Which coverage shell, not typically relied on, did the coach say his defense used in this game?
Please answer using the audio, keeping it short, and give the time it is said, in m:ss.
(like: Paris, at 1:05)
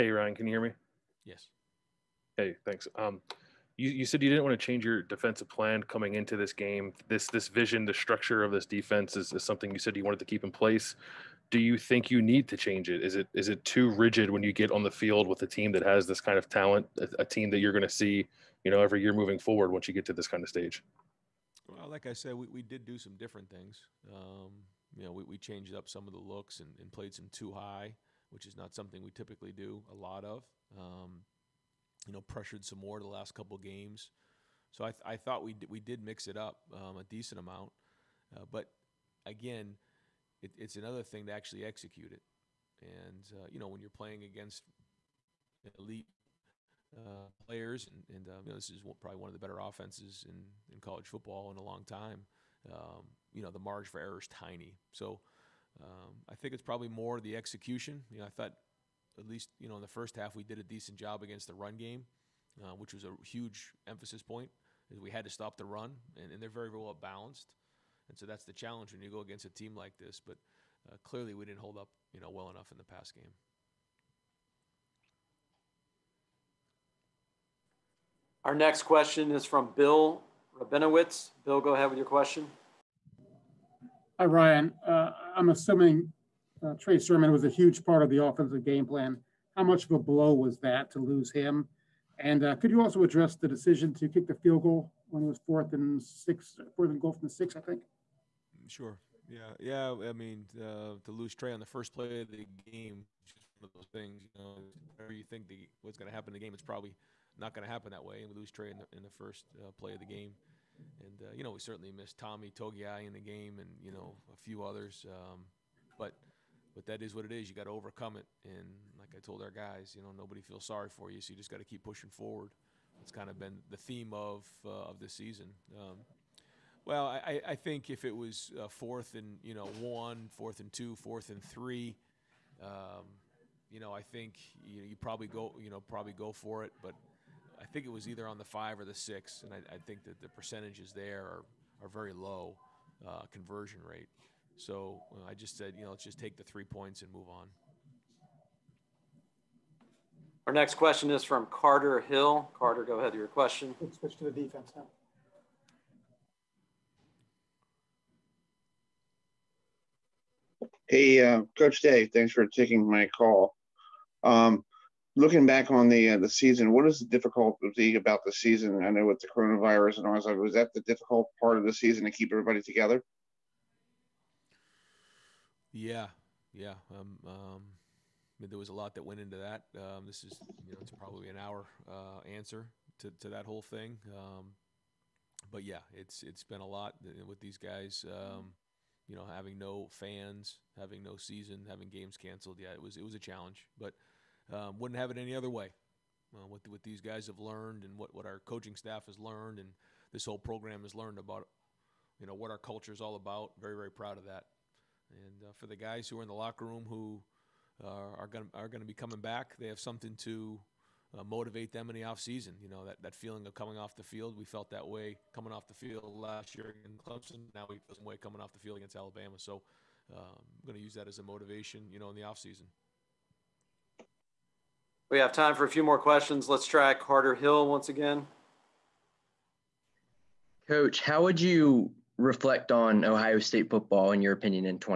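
two high, at 0:27.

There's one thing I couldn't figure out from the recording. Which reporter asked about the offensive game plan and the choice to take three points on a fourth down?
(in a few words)
Bill Rabinowitz.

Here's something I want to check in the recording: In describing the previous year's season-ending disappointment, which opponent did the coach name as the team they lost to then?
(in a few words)
Clemson.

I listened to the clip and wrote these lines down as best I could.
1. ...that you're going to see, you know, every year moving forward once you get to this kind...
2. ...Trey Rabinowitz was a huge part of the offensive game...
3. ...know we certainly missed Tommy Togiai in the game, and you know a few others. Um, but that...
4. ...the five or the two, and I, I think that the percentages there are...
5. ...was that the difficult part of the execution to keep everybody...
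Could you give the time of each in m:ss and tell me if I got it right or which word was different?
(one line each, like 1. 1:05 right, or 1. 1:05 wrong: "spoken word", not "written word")
1. 0:17 right
2. 1:26 wrong: "Sermon", not "Rabinowitz"
3. 1:51 right
4. 2:18 wrong: "six", not "two"
5. 2:50 wrong: "season", not "execution".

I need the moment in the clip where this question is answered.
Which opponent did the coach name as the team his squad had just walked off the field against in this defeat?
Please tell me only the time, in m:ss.
3:38.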